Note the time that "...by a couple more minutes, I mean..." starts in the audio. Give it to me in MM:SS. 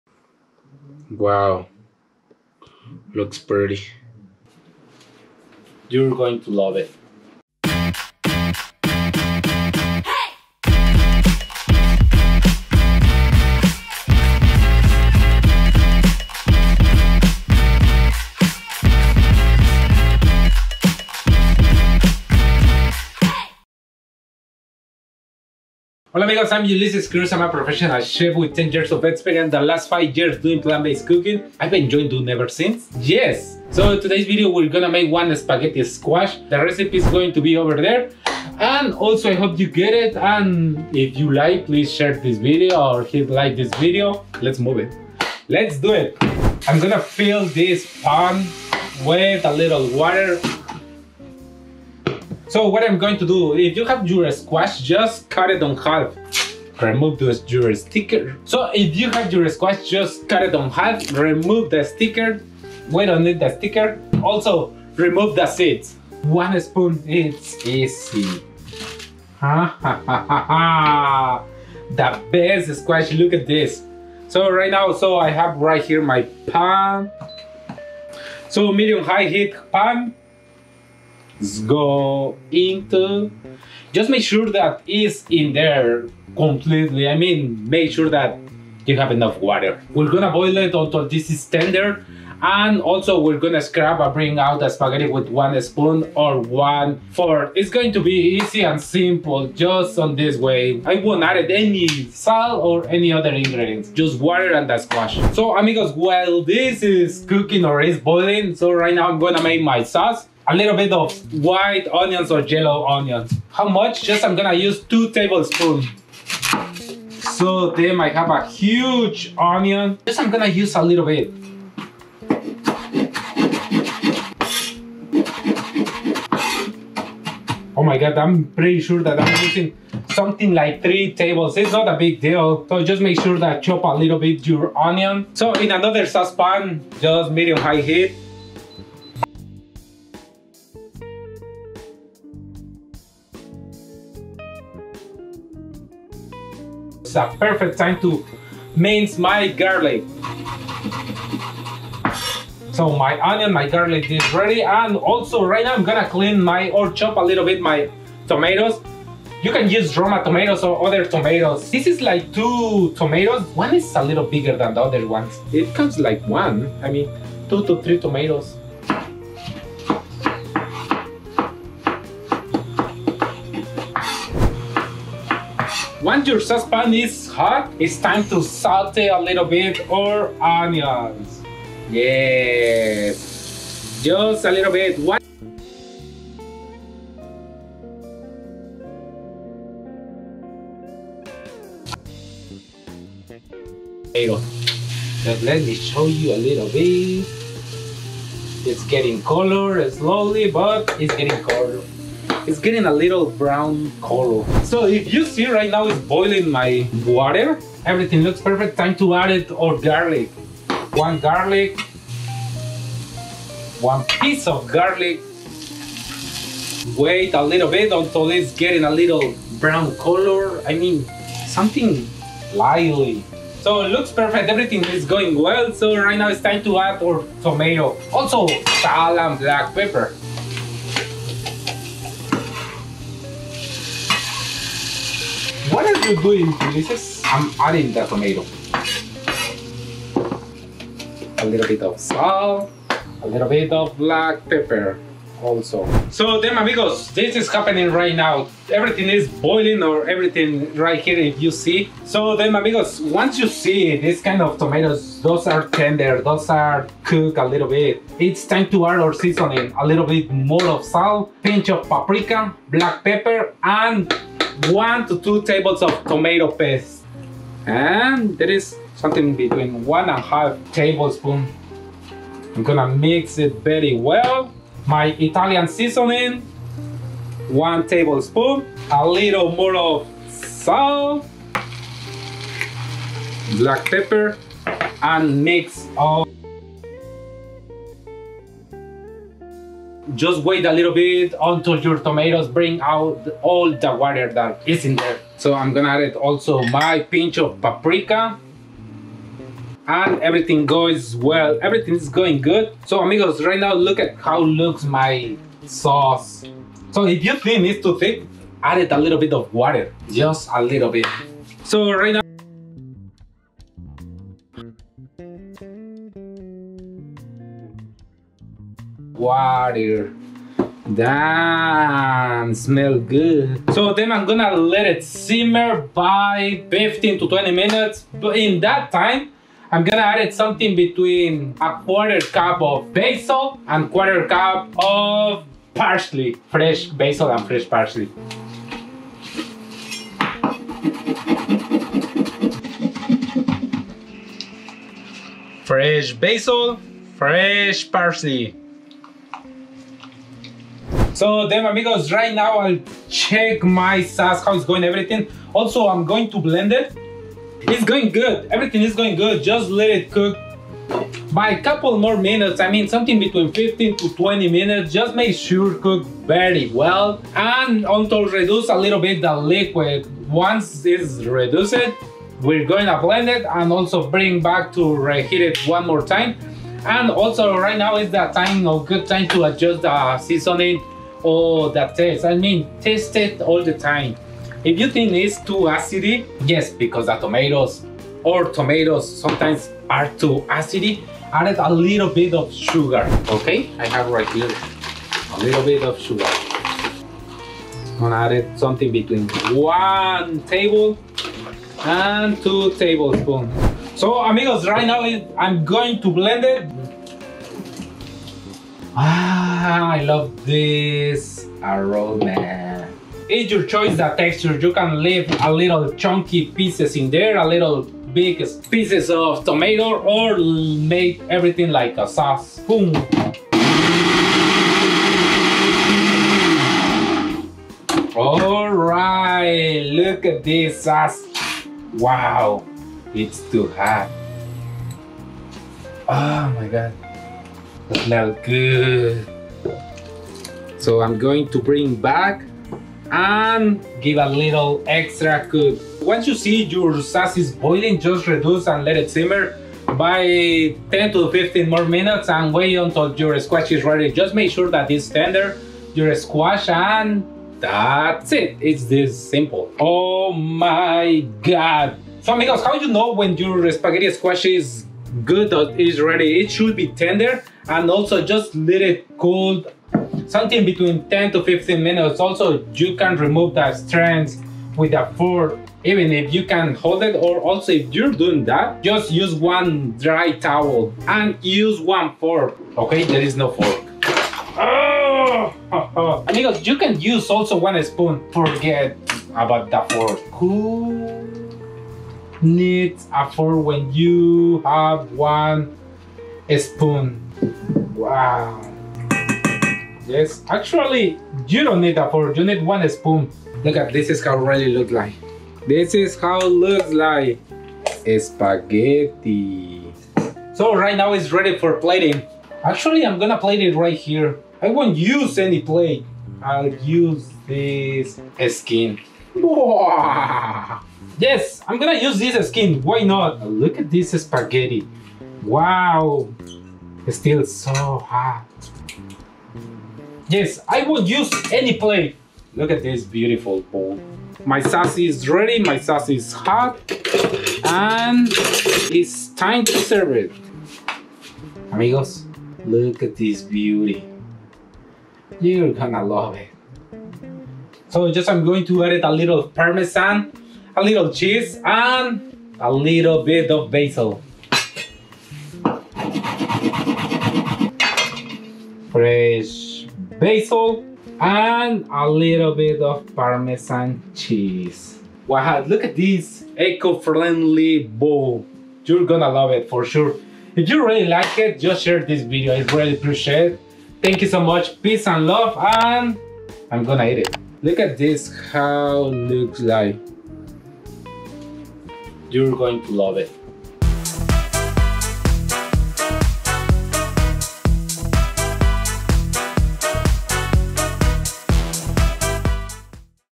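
06:01.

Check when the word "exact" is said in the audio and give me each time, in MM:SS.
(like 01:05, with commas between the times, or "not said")
not said.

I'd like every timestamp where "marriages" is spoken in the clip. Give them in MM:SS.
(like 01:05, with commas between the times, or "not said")
not said.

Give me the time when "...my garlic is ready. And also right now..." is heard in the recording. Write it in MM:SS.
02:33.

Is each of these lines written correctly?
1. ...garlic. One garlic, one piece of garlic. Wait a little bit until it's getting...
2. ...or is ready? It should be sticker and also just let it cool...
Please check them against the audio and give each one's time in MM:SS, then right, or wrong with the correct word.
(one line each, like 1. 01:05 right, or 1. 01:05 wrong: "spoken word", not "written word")
1. 03:29 right
2. 07:45 wrong: "tender", not "sticker".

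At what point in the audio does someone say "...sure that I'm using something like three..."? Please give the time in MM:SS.
02:08.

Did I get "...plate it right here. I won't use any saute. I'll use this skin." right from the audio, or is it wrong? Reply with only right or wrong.
wrong.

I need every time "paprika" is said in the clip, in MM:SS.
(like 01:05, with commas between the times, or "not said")
04:21, 04:57.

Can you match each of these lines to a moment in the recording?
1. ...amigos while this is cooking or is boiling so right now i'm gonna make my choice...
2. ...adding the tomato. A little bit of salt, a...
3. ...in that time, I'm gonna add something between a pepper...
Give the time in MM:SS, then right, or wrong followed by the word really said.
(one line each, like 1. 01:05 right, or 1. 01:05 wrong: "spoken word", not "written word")
1. 01:45 wrong: "sauce", not "choice"
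2. 03:57 right
3. 05:28 wrong: "quarter", not "pepper".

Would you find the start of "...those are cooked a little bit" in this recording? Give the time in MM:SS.
04:16.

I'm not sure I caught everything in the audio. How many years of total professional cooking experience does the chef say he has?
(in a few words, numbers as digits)
10 years.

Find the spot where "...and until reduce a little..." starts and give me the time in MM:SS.
06:07.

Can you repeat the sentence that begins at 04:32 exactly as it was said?
I'm gonna mix it very well.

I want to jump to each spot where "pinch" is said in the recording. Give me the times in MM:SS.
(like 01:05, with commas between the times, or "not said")
04:21, 04:56.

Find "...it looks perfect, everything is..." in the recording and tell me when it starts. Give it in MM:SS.
03:43.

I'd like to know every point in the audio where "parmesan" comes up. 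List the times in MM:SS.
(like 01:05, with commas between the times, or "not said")
09:09, 09:23.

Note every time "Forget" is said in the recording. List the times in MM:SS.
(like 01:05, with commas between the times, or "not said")
08:08.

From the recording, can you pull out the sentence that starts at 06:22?
I mean, taste it all the time.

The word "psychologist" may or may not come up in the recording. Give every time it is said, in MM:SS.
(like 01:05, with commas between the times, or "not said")
not said.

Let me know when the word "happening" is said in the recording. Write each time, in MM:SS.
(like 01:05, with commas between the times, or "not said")
04:07.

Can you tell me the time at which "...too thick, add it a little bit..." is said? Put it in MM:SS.
05:07.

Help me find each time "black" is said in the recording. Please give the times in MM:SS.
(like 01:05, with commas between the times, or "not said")
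03:49, 04:03, 04:22, 04:43.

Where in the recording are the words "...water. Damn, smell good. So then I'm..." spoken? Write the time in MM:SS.
05:19.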